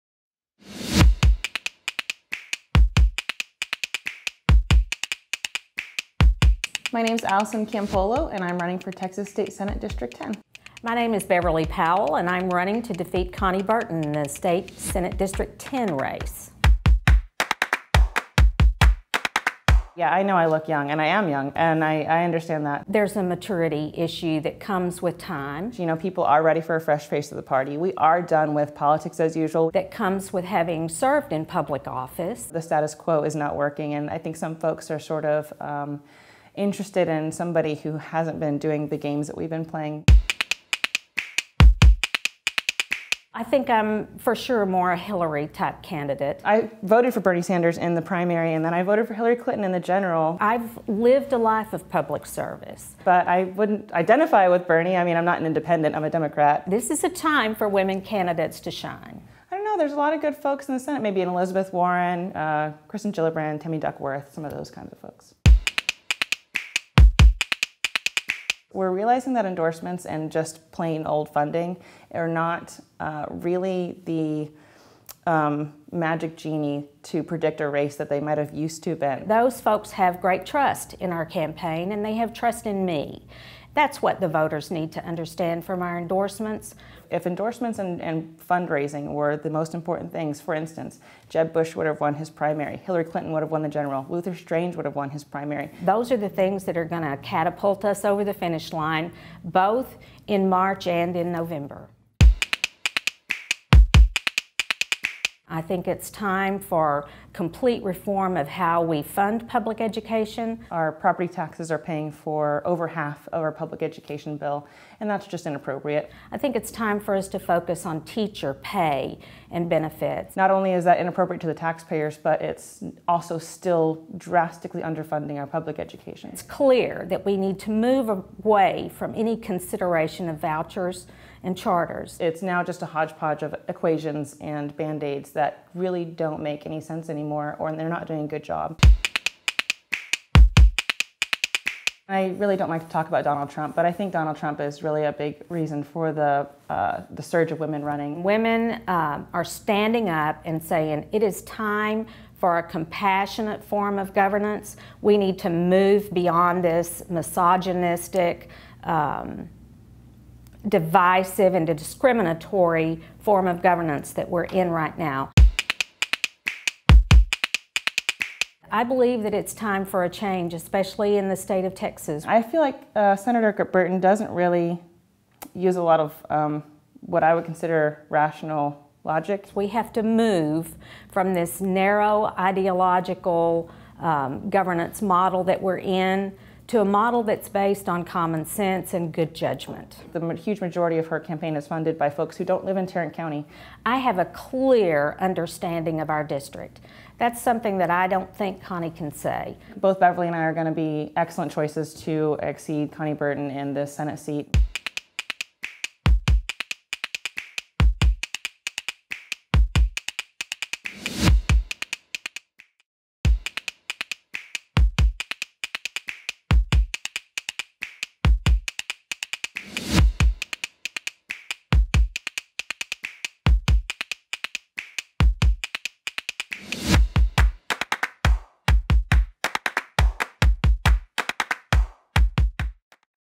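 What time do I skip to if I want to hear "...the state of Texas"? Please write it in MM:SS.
02:51.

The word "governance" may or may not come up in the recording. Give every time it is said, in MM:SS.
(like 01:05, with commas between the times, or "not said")
02:34, 02:43, 03:04.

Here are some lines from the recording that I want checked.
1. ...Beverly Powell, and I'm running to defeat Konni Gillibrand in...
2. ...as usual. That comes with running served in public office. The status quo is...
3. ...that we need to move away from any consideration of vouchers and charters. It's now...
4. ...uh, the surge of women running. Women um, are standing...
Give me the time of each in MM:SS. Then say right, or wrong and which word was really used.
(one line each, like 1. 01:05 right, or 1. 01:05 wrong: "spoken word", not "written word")
1. 00:11 wrong: "Burton", not "Gillibrand"
2. 00:29 wrong: "having", not "running"
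3. 02:07 right
4. 02:26 right.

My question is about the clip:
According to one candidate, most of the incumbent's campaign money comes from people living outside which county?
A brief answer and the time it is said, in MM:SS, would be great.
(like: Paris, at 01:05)
Tarrant County, at 03:12.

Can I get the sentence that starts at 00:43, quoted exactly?
I think I'm for sure more a Hillary type candidate.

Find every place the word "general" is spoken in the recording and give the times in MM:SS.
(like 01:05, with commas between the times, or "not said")
00:49, 01:33.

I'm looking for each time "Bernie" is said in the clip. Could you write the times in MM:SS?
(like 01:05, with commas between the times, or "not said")
00:47, 00:54.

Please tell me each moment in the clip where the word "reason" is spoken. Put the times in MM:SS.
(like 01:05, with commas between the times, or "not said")
02:25.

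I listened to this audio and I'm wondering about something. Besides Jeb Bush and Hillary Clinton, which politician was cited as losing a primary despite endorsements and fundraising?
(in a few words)
Luther Strange.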